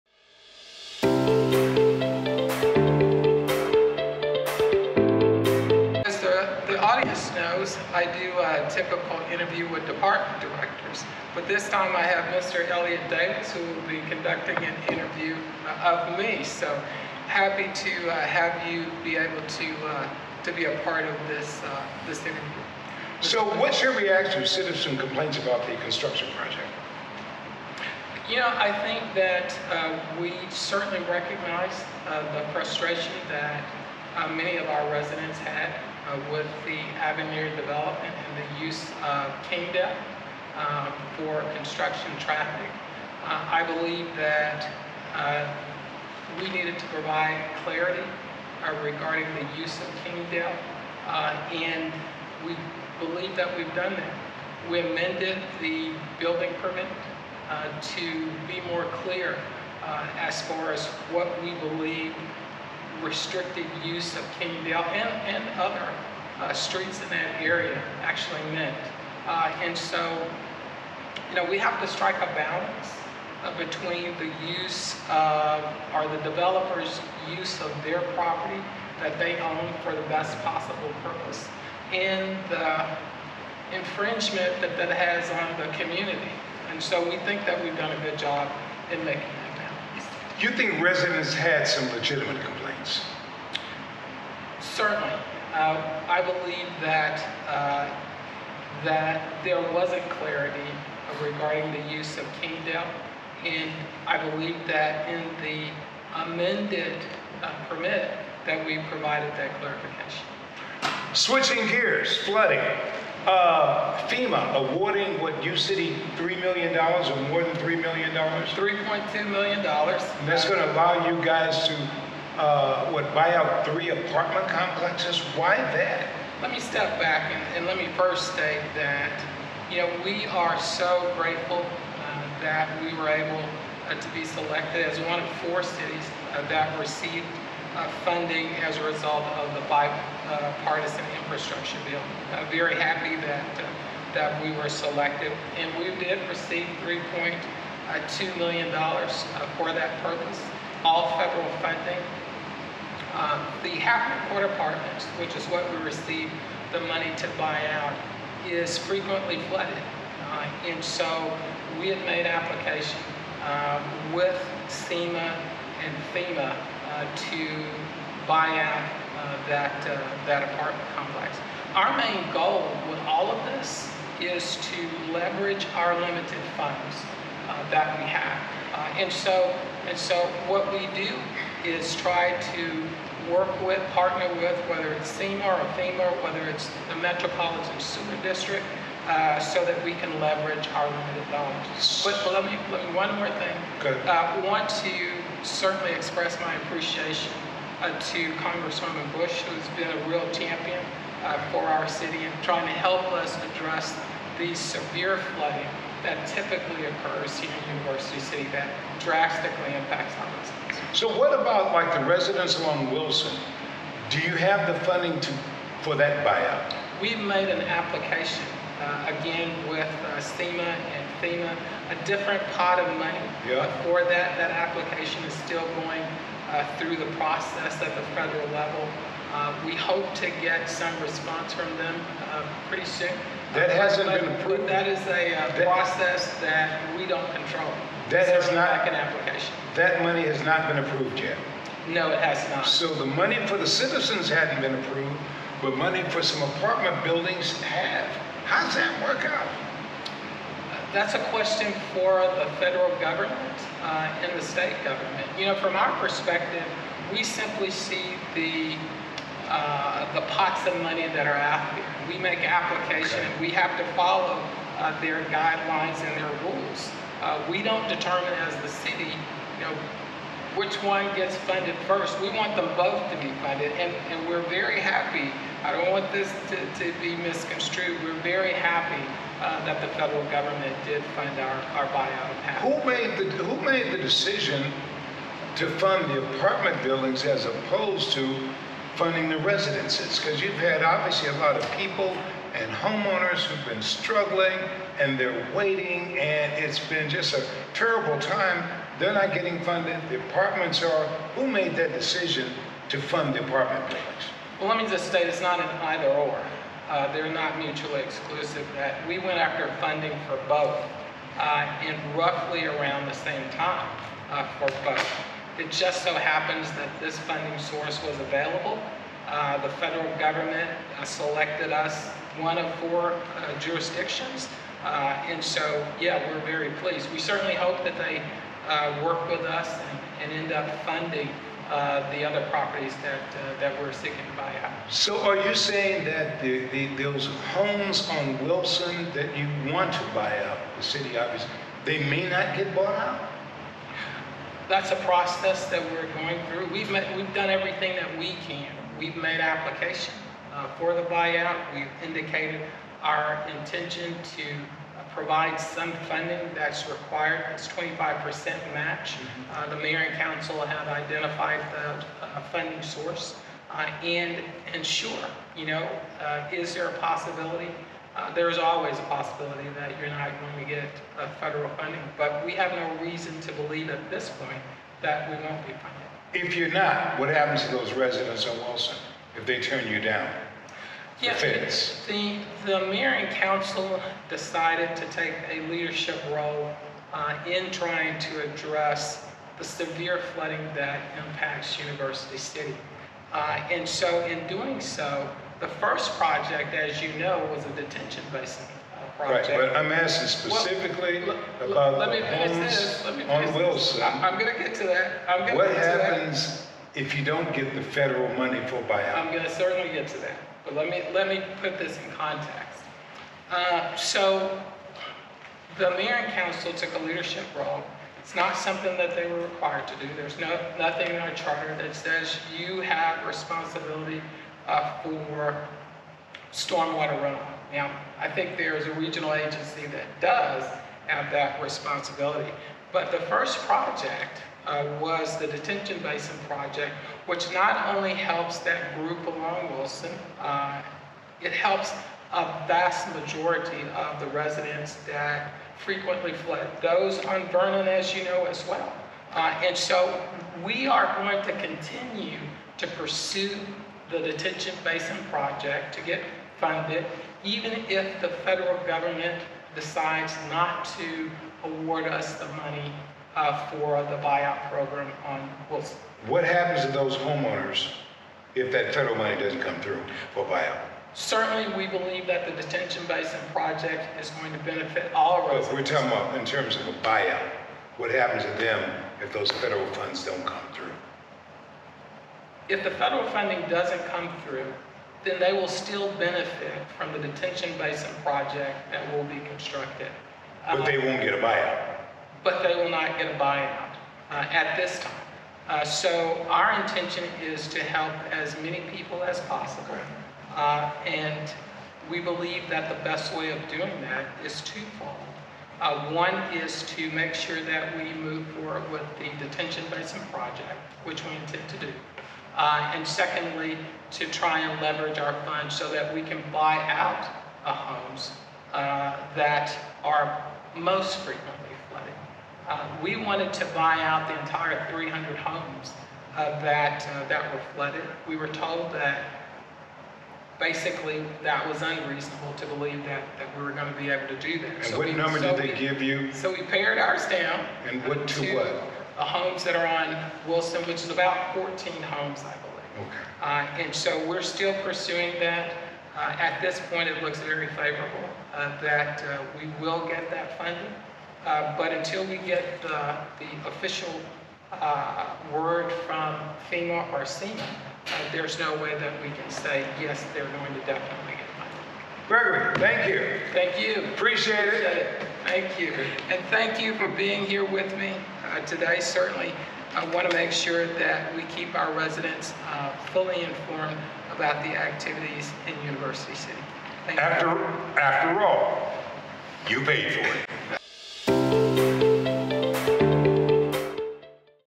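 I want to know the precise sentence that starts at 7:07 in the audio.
Now, I think there is a regional agency that does have that responsibility.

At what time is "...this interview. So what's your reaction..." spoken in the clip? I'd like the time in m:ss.
0:22.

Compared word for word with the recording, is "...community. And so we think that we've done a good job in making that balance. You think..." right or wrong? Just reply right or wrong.
right.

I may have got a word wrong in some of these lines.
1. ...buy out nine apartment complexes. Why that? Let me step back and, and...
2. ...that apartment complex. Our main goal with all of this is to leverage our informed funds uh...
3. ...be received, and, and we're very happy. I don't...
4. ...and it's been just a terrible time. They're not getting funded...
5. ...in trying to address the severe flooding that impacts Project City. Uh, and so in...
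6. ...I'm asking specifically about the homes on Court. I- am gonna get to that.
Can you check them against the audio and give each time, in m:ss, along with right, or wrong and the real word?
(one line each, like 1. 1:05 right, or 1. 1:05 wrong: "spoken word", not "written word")
1. 2:03 wrong: "three", not "nine"
2. 2:50 wrong: "limited", not "informed"
3. 4:33 wrong: "funded", not "received"
4. 4:56 right
5. 6:27 wrong: "University", not "Project"
6. 6:39 wrong: "Wilson", not "Court".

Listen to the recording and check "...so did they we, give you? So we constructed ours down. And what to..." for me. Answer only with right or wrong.
wrong.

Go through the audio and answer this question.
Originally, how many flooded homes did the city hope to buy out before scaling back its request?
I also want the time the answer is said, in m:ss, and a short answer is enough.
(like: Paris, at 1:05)
300, at 8:44.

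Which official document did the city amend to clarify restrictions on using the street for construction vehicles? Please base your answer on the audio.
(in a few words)
building permit.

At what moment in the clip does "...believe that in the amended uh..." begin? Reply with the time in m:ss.
1:44.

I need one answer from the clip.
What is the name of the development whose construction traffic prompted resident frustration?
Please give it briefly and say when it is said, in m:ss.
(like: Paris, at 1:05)
Avenir, at 0:36.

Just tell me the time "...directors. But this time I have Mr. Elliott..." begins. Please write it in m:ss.
0:10.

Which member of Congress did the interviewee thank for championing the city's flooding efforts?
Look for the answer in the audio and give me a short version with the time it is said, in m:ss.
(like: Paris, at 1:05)
Congresswoman Bush, at 3:18.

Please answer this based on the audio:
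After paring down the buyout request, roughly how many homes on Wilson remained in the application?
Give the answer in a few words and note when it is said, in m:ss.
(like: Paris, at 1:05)
14, at 9:01.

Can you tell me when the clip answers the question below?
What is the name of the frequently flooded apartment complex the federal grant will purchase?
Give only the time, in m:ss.
2:33.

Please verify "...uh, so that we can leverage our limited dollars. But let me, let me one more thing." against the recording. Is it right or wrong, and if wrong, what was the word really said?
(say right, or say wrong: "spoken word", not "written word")
right.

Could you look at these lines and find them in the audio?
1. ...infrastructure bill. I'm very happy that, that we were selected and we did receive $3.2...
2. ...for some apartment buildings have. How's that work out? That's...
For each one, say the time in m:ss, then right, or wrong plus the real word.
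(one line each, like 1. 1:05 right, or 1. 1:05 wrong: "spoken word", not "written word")
1. 2:21 right
2. 4:06 right.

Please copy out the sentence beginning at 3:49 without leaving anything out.
Uh, we hope to get some response from them uh, pretty soon.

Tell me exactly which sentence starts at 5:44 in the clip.
that's a process that we're going through.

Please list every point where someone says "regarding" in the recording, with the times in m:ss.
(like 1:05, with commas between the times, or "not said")
0:48, 1:41.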